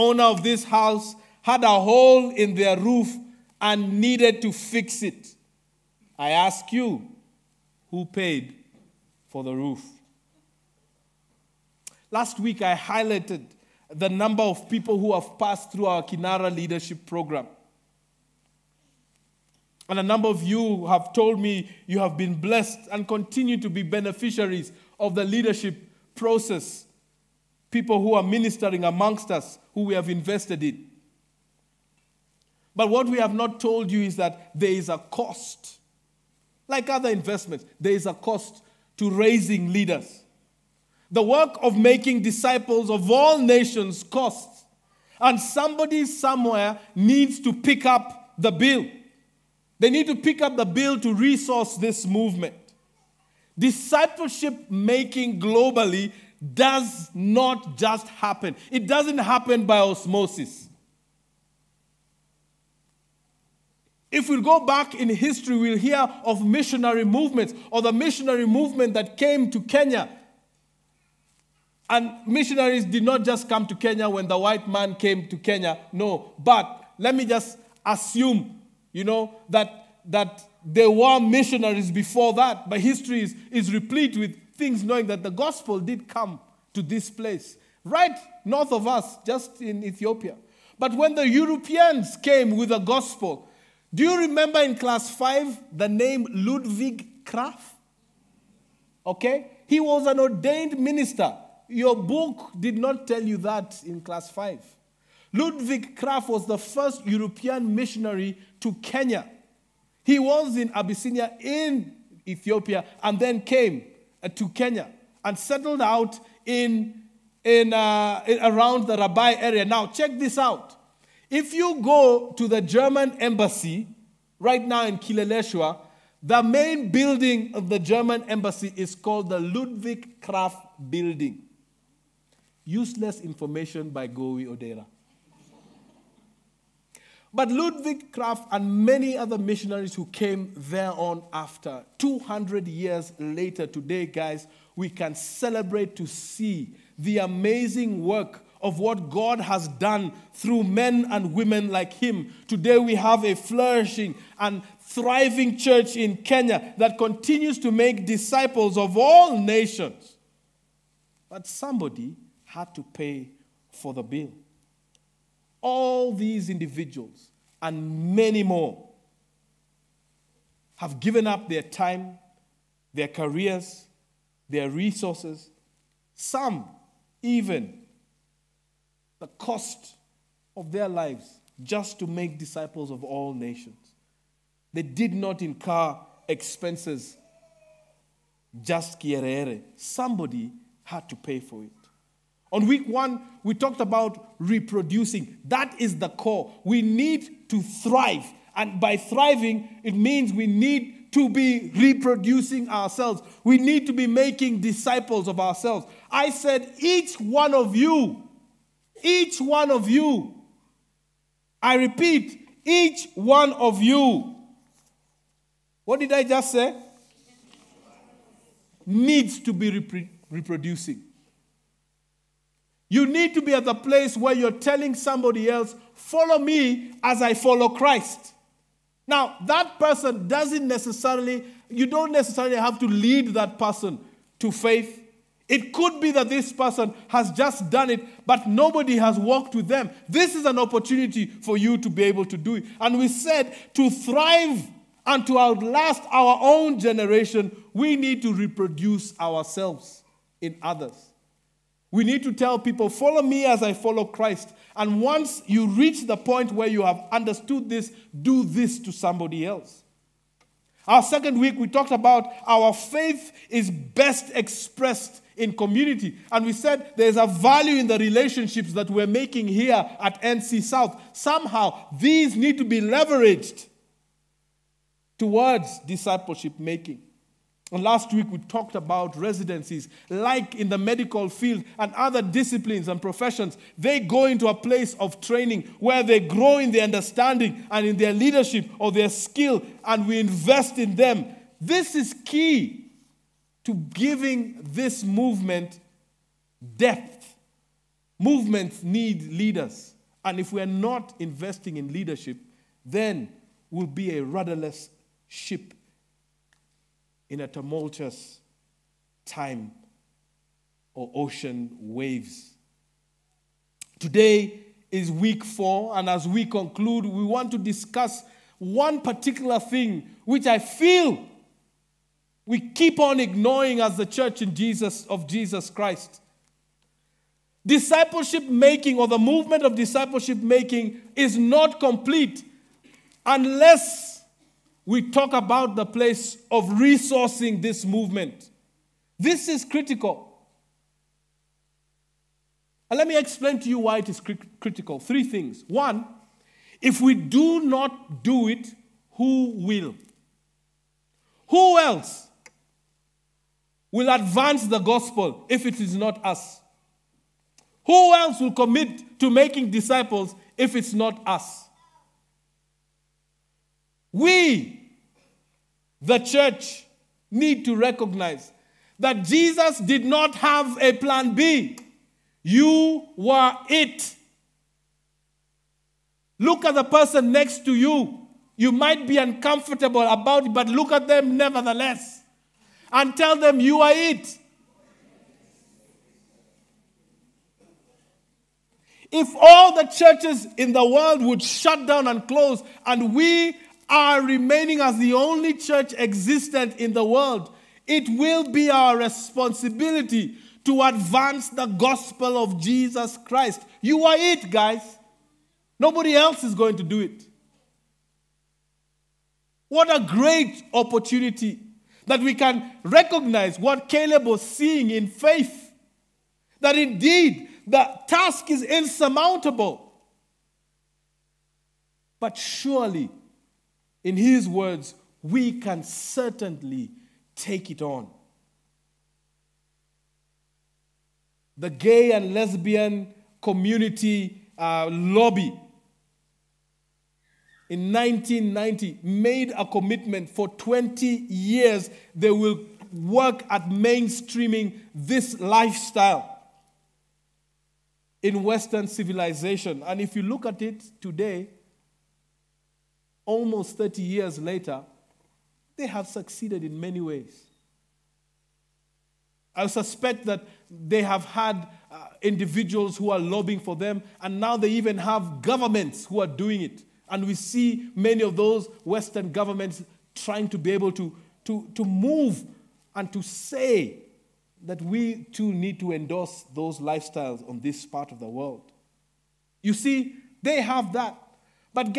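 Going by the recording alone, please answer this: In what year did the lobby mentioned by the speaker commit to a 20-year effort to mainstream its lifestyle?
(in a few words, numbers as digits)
1990.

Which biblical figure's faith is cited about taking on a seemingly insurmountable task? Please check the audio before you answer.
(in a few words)
Caleb.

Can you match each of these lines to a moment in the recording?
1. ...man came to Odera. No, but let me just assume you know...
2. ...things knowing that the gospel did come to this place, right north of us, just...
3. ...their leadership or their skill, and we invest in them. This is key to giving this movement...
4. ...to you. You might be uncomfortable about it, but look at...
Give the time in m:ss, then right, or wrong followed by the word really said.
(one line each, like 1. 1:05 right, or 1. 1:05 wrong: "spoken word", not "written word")
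1. 1:14 wrong: "Kenya", not "Odera"
2. 1:24 right
3. 4:47 right
4. 6:17 right.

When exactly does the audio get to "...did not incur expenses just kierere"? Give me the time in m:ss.
3:04.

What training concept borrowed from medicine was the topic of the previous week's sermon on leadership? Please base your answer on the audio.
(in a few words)
residencies.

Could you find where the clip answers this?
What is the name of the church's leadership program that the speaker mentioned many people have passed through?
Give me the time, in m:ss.
0:16.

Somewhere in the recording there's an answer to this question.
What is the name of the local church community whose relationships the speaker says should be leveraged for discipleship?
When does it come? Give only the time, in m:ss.
4:30.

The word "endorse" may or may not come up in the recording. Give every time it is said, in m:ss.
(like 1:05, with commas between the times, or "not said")
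7:55.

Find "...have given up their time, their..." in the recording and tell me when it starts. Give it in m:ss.
2:50.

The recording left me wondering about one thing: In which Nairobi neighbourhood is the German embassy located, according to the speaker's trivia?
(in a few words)
Kileleshwa.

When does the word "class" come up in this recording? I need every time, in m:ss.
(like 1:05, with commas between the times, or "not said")
1:34, 1:43.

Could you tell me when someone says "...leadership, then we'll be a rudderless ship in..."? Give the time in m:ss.
5:01.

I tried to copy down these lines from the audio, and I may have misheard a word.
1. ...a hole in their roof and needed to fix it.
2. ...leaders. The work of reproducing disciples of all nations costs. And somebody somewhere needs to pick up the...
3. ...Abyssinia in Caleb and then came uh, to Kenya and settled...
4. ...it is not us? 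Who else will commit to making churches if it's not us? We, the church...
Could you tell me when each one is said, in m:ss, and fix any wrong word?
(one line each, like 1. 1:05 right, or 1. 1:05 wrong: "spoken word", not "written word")
1. 0:01 right
2. 0:39 wrong: "making", not "reproducing"
3. 1:50 wrong: "Ethiopia", not "Caleb"
4. 5:55 wrong: "disciples", not "churches".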